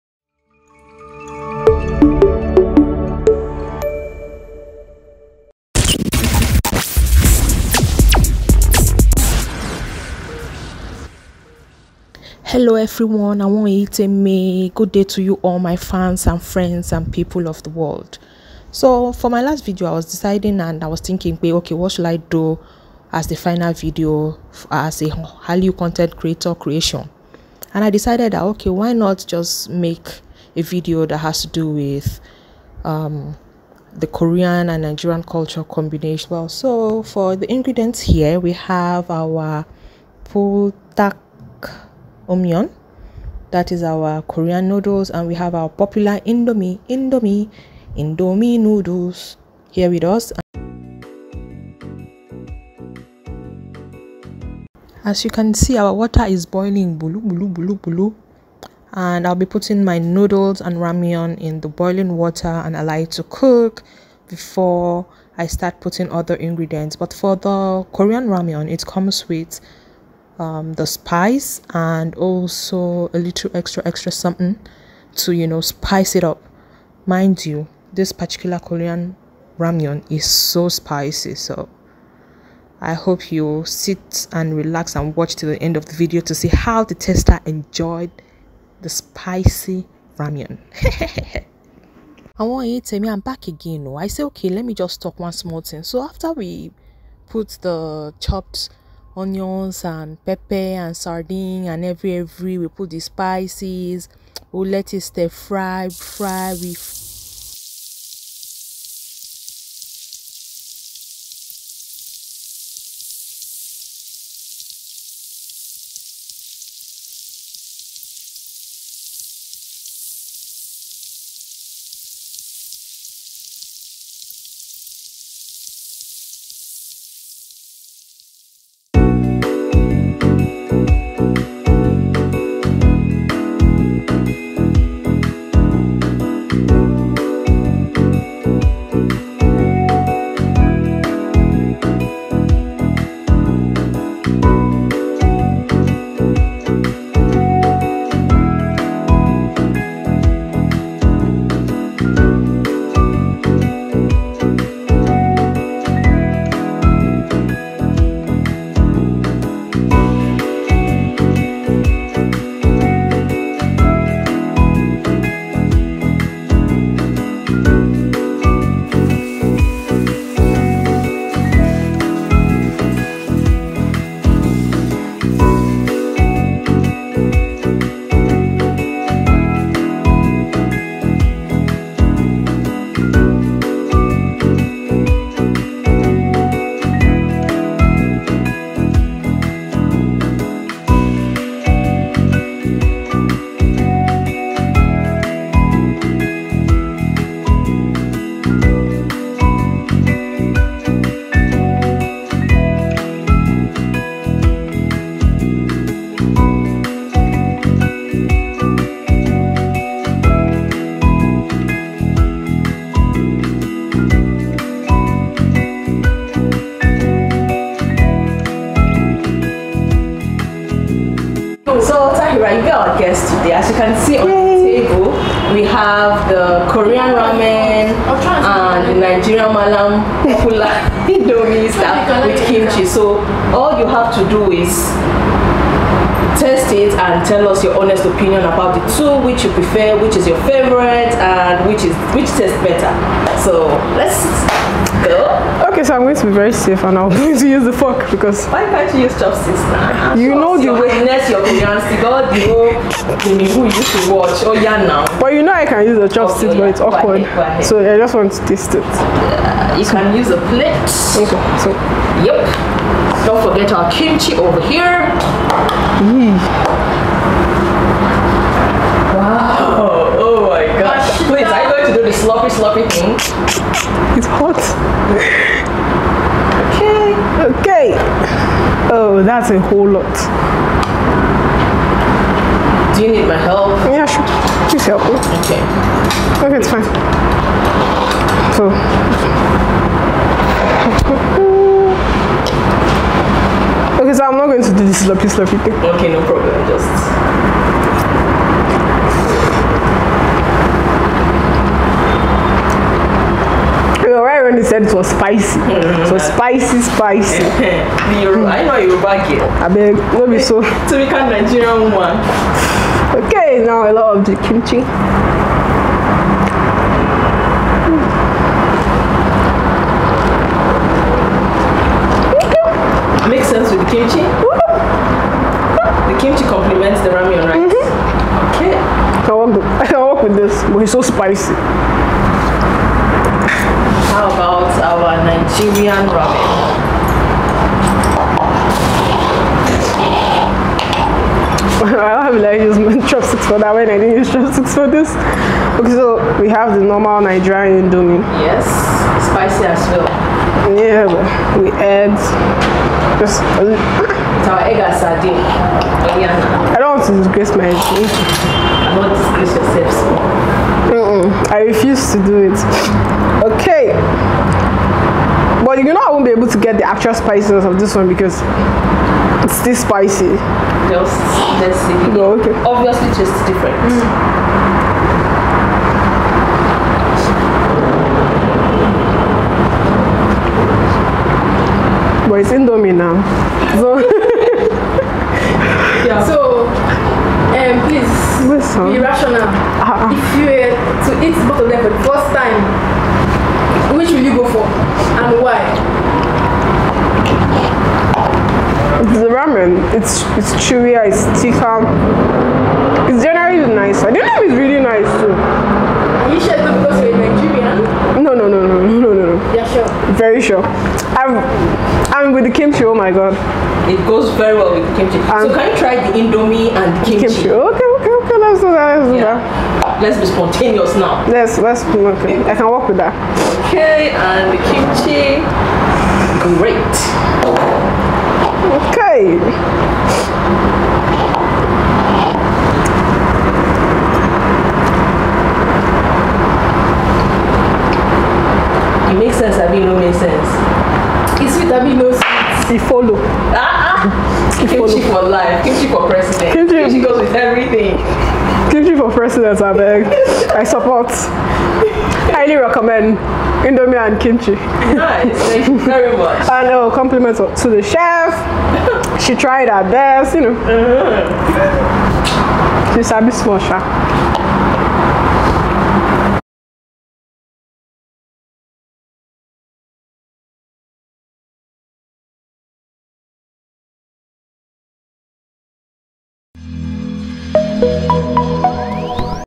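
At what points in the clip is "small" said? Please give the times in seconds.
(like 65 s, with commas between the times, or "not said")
95 s, 463 s.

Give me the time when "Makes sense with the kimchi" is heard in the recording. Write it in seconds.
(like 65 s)
323 s.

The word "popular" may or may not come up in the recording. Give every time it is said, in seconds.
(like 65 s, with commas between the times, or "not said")
45 s, 230 s.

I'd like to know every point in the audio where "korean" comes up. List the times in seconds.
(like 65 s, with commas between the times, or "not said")
34 s, 44 s, 67 s, 78 s, 226 s.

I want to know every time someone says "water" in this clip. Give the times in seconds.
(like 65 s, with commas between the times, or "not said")
55 s, 62 s.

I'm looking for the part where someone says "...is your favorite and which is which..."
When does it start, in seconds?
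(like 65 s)
240 s.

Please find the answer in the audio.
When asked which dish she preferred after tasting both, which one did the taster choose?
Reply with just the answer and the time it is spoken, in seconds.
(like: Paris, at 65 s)
The ramen, at 399 s.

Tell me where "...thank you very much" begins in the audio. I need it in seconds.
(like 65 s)
455 s.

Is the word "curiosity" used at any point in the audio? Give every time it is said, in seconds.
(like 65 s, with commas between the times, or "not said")
251 s.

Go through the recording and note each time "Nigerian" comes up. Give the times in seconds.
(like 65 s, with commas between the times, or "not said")
34 s, 229 s, 311 s, 335 s, 347 s, 407 s.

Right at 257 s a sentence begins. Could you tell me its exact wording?
so i just want to taste it uh, you can use a plate okay so yep don't forget our kimchi over here.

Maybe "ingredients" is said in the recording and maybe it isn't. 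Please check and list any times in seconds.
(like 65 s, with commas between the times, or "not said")
37 s, 66 s.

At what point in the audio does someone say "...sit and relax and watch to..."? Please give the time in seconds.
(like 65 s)
83 s.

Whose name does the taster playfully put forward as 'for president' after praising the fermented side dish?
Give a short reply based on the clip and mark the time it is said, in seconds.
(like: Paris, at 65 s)
Kelechi, at 448 s.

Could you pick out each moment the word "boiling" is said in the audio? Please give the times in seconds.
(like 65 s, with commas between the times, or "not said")
56 s, 61 s.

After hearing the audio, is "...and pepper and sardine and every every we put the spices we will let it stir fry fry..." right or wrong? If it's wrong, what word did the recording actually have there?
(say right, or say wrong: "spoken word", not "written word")
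right.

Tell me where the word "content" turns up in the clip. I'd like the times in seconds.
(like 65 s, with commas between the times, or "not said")
25 s.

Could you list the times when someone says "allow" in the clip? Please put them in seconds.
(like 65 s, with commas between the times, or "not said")
62 s.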